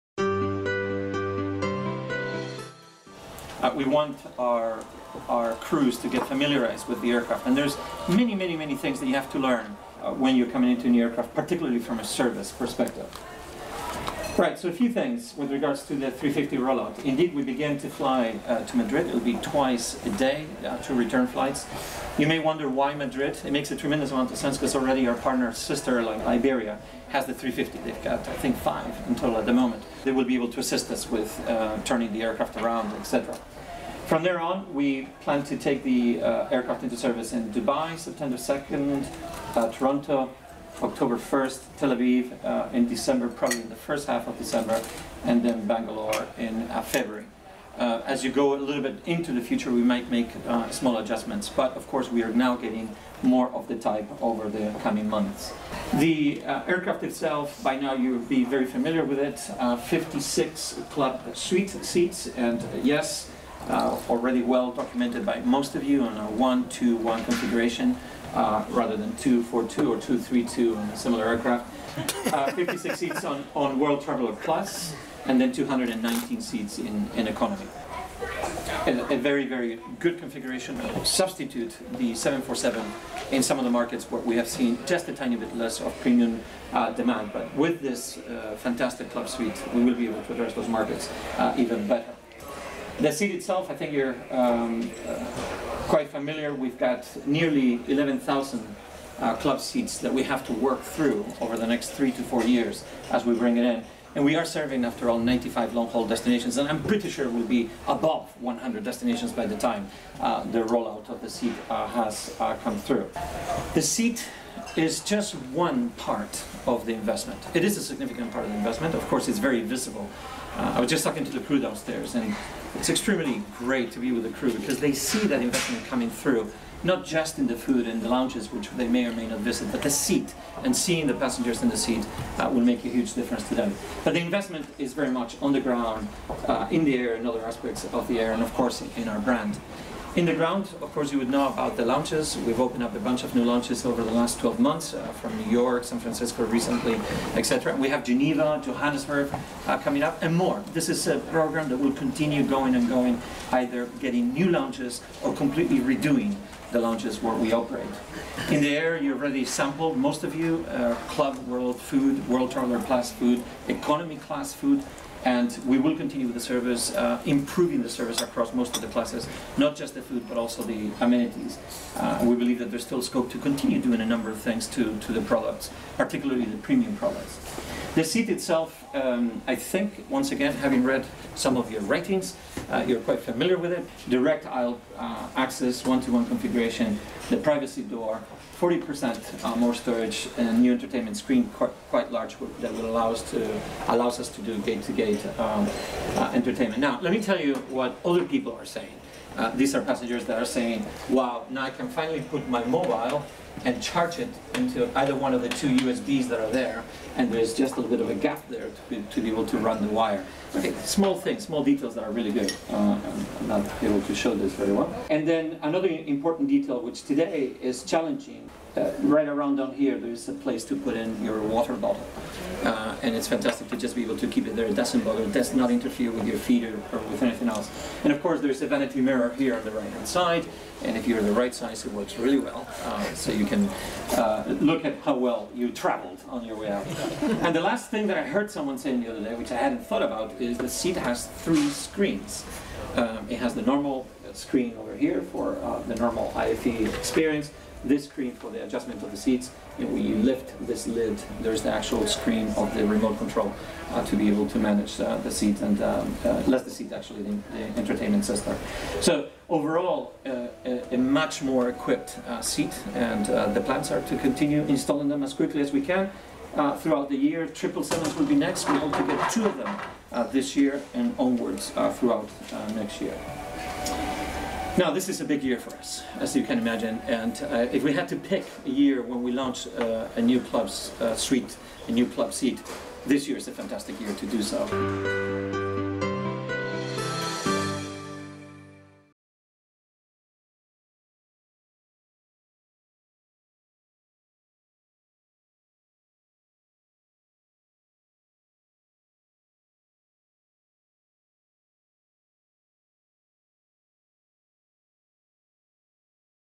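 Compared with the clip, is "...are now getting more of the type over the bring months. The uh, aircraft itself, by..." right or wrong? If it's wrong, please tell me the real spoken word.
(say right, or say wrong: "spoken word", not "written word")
wrong: "coming", not "bring".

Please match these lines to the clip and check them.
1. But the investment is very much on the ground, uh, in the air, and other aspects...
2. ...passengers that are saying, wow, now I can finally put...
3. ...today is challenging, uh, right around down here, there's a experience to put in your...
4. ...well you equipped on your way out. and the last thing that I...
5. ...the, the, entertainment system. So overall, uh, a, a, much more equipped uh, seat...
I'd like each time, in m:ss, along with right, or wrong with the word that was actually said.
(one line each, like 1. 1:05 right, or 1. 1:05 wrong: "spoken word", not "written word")
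1. 2:14 right
2. 3:19 right
3. 3:37 wrong: "place", not "experience"
4. 3:55 wrong: "traveled", not "equipped"
5. 4:17 right.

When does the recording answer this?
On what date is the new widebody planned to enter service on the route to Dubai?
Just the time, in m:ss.
0:37.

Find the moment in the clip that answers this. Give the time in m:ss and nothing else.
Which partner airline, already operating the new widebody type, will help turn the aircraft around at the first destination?
0:26.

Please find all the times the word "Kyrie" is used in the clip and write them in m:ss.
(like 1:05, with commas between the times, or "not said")
not said.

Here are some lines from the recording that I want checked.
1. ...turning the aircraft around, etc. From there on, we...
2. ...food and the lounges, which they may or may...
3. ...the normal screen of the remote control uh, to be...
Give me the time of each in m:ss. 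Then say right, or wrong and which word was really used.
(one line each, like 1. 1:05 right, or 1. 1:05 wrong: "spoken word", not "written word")
1. 0:31 right
2. 2:07 right
3. 4:11 wrong: "actual", not "normal".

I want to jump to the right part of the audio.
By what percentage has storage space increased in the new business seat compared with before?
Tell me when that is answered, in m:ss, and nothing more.
3:08.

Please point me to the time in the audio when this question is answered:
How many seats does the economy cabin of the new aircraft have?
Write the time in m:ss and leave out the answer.
1:15.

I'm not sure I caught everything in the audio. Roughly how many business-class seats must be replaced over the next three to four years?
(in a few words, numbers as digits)
11,000.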